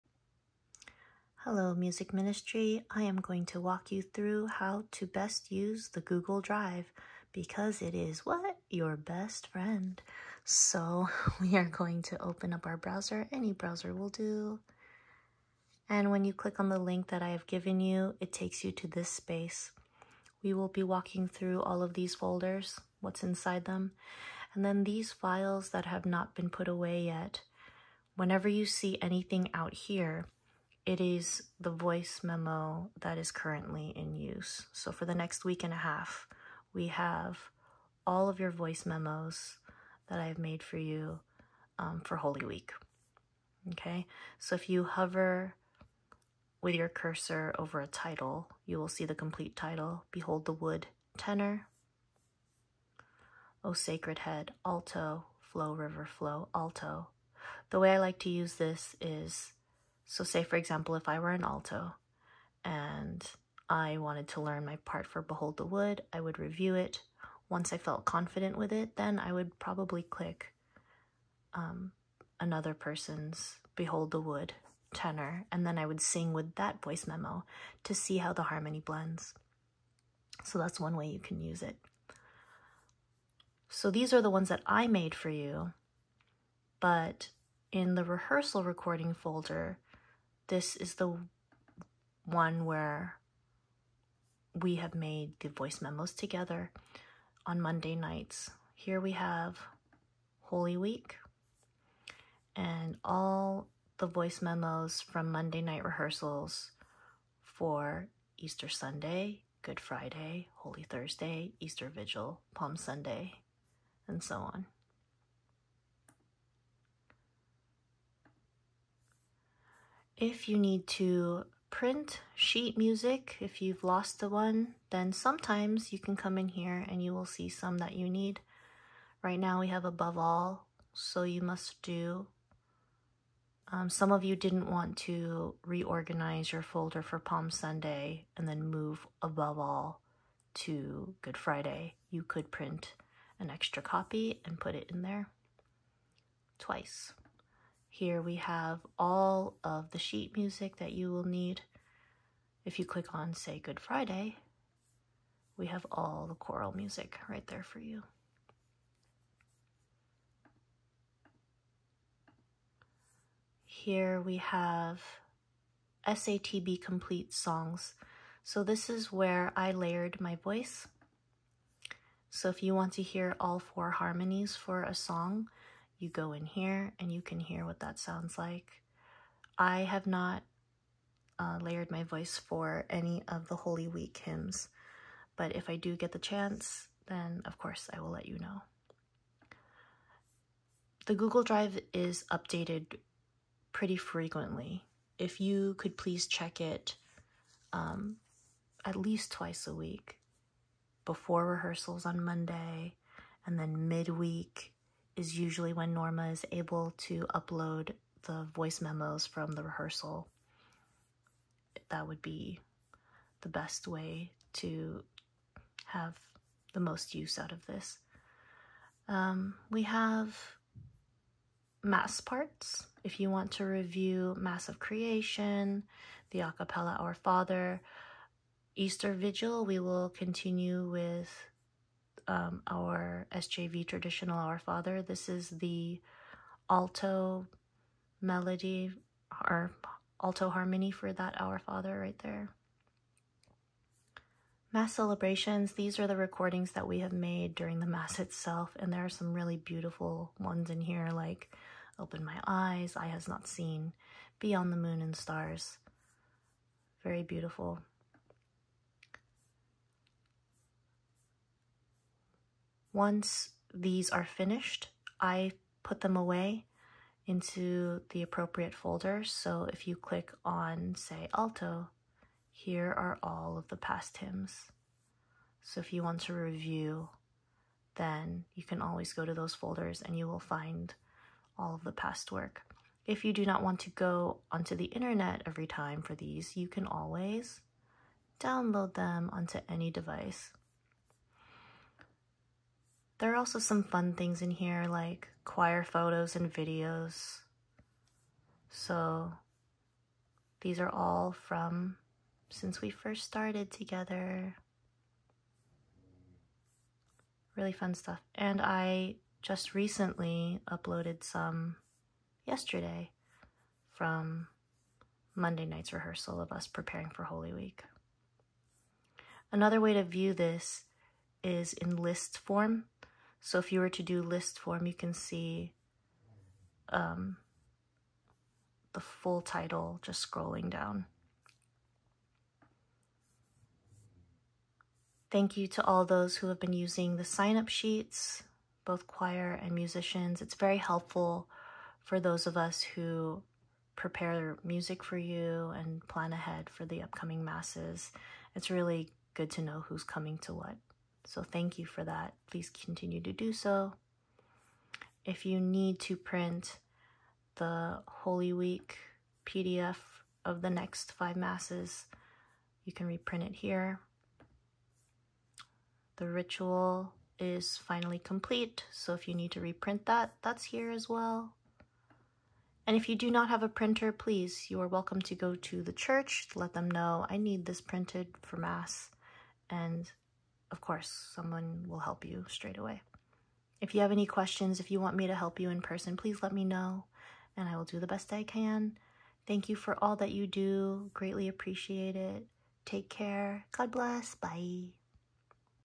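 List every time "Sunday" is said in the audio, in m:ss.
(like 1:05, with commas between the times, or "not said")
1:48, 1:52, 2:17.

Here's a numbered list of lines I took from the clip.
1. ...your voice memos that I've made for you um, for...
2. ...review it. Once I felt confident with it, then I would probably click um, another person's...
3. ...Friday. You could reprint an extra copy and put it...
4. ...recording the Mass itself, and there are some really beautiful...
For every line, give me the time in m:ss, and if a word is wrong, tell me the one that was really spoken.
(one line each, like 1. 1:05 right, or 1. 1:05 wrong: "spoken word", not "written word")
1. 0:38 right
2. 1:06 right
3. 2:21 wrong: "print", not "reprint"
4. 4:07 wrong: "during", not "recording".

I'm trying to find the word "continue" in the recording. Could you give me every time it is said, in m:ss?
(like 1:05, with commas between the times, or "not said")
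3:50, 5:52.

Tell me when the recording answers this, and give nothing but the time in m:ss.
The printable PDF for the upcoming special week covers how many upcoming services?
6:01.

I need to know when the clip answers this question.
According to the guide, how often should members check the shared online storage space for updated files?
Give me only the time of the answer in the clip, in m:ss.
3:19.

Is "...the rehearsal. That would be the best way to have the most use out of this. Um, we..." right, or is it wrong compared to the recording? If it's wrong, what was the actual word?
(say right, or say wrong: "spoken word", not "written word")
right.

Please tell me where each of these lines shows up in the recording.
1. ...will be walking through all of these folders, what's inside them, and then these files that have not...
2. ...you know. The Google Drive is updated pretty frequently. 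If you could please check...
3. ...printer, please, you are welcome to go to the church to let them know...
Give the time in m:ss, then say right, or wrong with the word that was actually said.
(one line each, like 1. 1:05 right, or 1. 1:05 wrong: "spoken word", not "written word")
1. 0:20 right
2. 3:08 right
3. 6:13 right.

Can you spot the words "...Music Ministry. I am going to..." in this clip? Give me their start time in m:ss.
0:01.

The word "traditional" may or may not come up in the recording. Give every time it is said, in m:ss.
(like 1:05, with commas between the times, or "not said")
3:53.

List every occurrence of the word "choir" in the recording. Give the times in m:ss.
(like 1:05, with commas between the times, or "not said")
4:55, 5:39.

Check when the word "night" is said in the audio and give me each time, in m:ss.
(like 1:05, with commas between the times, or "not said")
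1:37, 1:45, 5:15.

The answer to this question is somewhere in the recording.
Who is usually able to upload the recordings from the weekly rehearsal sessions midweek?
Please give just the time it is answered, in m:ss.
3:25.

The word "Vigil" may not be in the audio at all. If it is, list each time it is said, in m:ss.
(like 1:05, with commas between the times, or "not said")
1:51, 3:49.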